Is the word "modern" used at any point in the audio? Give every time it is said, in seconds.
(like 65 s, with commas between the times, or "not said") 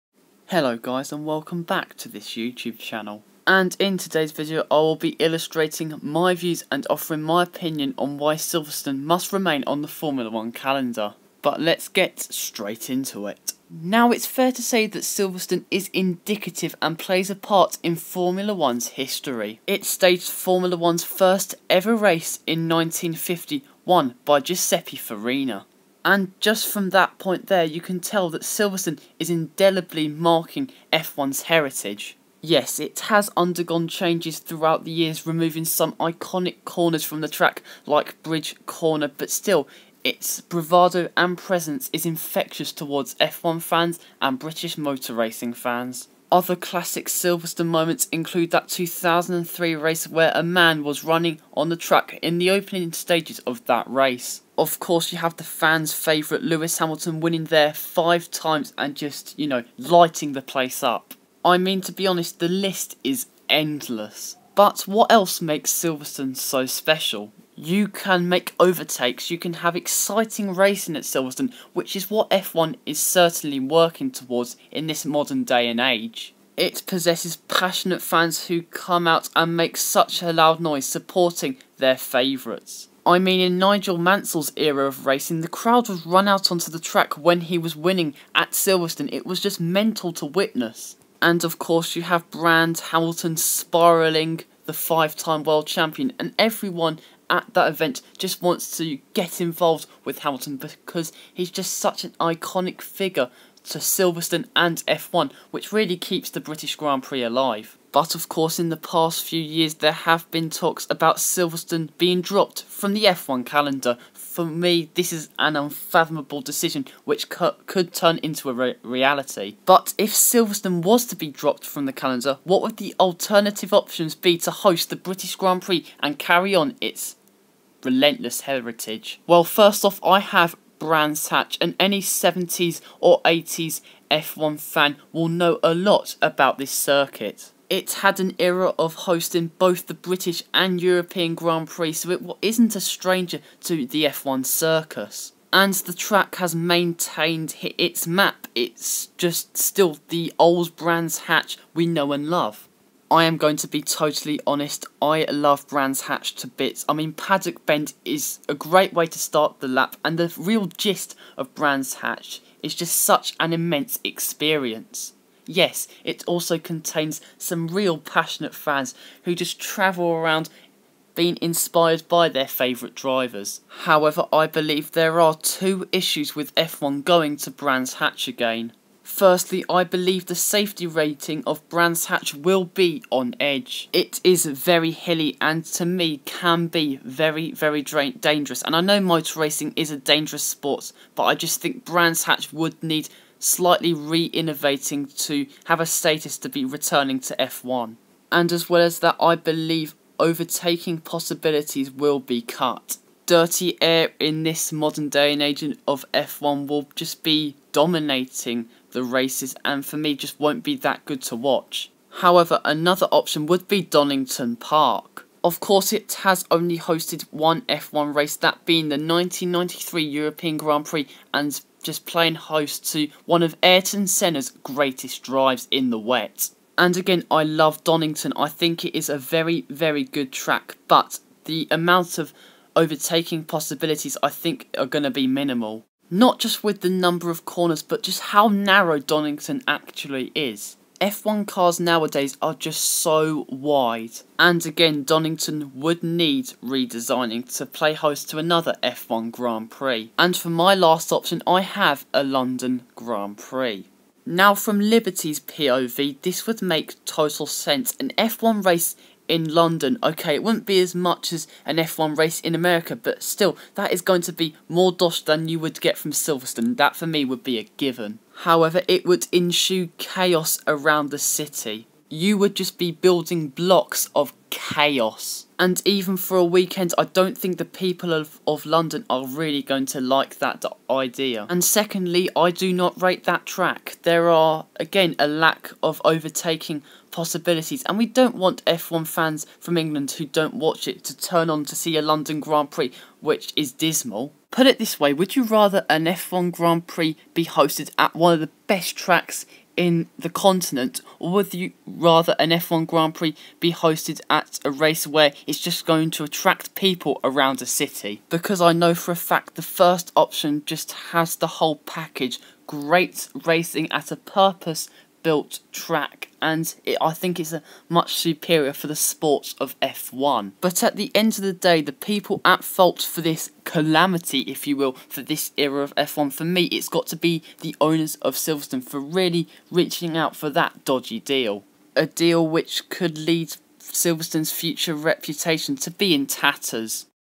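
75 s, 204 s.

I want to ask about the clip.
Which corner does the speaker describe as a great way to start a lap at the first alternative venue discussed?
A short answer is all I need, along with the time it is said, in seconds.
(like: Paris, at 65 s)
Paddock Bend, at 157 s.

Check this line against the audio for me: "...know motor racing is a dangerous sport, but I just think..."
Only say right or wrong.
right.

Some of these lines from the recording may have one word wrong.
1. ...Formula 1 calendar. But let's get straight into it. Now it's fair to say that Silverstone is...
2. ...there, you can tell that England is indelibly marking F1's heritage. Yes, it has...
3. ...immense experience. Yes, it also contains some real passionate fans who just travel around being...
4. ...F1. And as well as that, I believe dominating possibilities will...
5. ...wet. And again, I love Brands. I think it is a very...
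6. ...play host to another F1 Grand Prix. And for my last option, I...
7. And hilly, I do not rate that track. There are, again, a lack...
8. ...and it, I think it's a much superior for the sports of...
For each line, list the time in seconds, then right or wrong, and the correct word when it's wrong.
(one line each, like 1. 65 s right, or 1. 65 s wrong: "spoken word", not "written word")
1. 9 s right
2. 27 s wrong: "Silverstone", not "England"
3. 163 s right
4. 197 s wrong: "overtaking", not "dominating"
5. 225 s wrong: "Donington", not "Brands"
6. 247 s right
7. 281 s wrong: "secondly", not "hilly"
8. 316 s right.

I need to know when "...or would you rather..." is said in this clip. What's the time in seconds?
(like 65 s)
301 s.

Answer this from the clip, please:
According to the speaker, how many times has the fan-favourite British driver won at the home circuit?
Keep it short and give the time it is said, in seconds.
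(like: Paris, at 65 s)
5, at 57 s.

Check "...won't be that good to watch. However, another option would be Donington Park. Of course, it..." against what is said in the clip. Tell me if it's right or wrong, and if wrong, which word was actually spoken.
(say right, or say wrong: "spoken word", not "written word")
right.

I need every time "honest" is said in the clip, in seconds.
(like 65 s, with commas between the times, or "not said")
62 s, 154 s.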